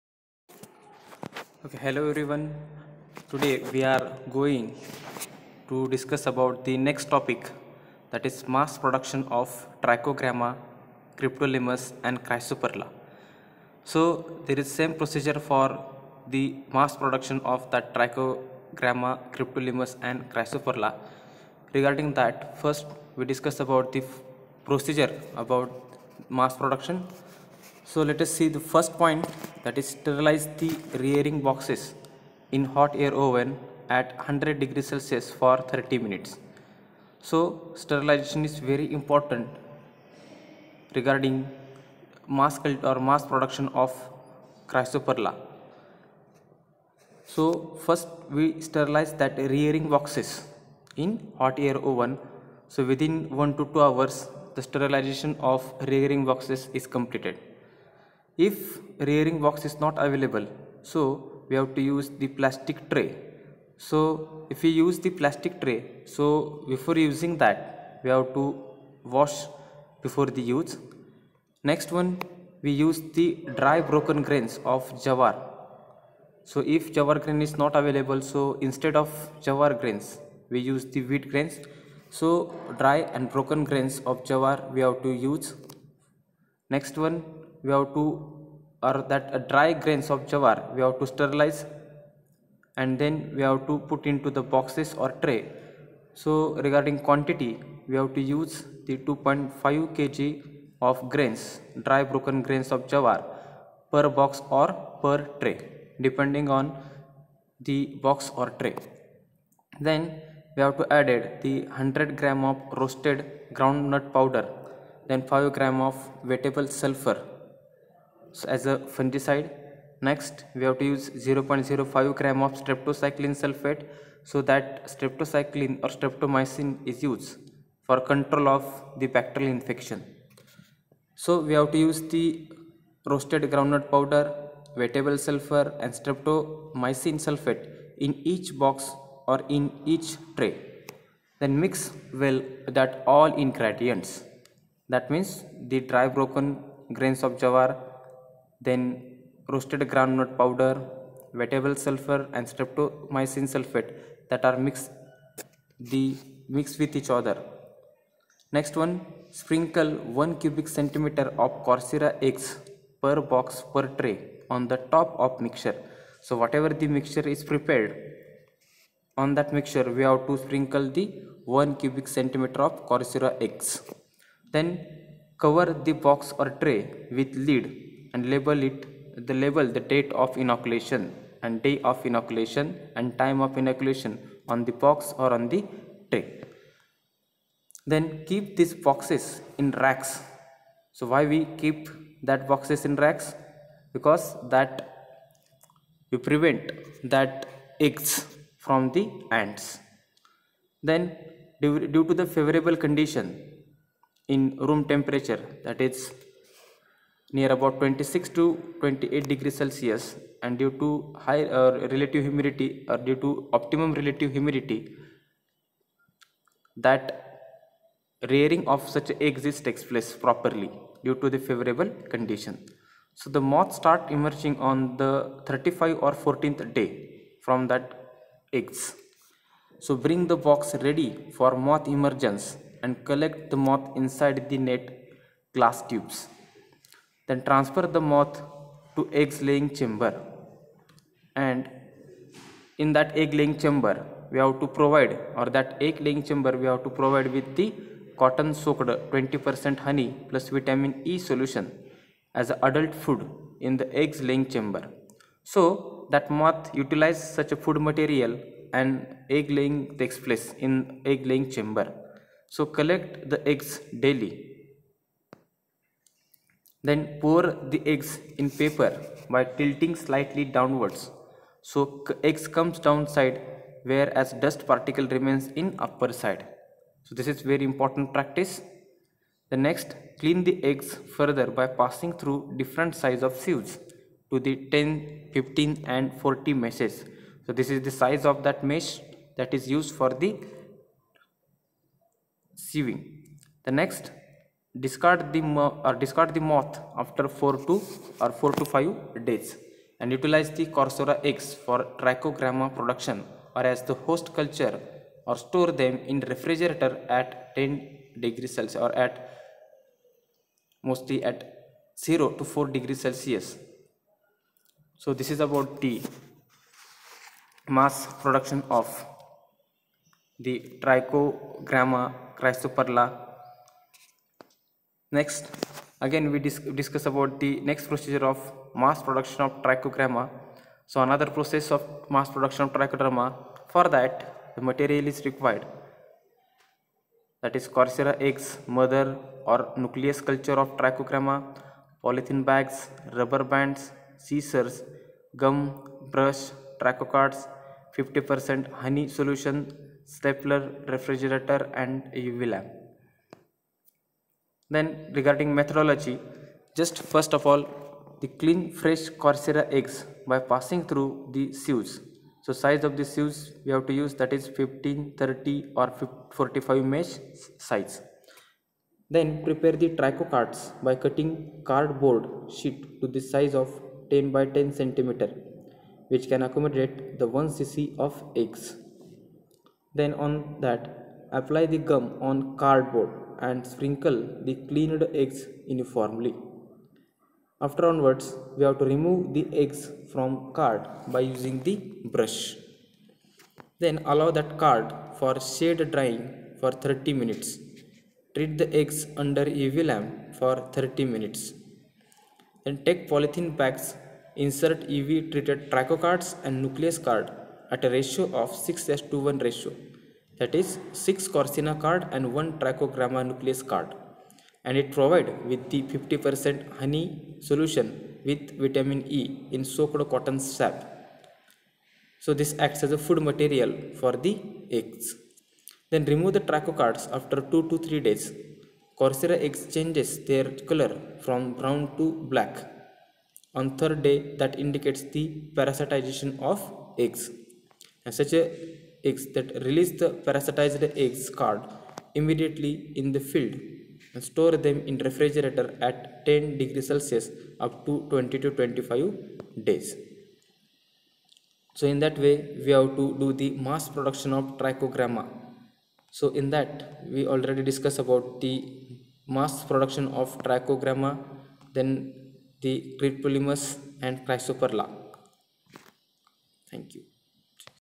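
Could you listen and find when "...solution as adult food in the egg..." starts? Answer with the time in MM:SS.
04:11.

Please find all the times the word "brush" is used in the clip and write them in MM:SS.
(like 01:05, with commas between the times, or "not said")
05:46, 06:32.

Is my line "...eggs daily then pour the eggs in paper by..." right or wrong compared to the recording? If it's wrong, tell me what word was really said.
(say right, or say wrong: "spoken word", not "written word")
right.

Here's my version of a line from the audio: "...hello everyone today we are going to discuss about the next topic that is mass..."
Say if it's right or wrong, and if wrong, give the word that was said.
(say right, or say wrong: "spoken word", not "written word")
right.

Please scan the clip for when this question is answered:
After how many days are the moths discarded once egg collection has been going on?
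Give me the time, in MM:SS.
04:58.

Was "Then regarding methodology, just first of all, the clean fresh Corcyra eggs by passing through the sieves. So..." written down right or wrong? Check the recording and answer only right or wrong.
right.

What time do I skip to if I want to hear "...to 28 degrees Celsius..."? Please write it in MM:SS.
03:28.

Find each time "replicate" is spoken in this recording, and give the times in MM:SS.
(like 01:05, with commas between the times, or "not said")
not said.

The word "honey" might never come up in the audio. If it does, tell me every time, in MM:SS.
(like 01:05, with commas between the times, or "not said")
04:09, 05:48, 06:56.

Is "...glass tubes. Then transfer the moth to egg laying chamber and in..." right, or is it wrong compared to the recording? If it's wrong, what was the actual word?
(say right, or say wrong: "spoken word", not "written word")
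right.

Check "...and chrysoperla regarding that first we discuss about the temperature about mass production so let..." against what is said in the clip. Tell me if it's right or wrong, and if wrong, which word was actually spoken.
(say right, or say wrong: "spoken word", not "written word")
wrong: "procedure", not "temperature".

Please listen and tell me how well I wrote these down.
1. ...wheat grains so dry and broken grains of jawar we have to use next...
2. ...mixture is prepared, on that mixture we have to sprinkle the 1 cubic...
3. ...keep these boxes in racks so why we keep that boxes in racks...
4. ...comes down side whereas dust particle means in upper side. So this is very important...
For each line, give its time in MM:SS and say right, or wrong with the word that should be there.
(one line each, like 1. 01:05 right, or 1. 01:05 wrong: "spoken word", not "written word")
1. 01:21 right
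2. 02:46 right
3. 03:08 right
4. 04:32 wrong: "remains", not "means".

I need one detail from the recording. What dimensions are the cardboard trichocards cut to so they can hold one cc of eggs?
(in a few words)
10 by 10 centimeter.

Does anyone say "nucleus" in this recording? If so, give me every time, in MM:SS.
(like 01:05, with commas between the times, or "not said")
05:39, 06:46, 06:53.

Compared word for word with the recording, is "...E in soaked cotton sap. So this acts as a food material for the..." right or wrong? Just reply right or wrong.
right.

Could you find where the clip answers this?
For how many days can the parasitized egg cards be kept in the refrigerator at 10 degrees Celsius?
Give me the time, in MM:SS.
07:28.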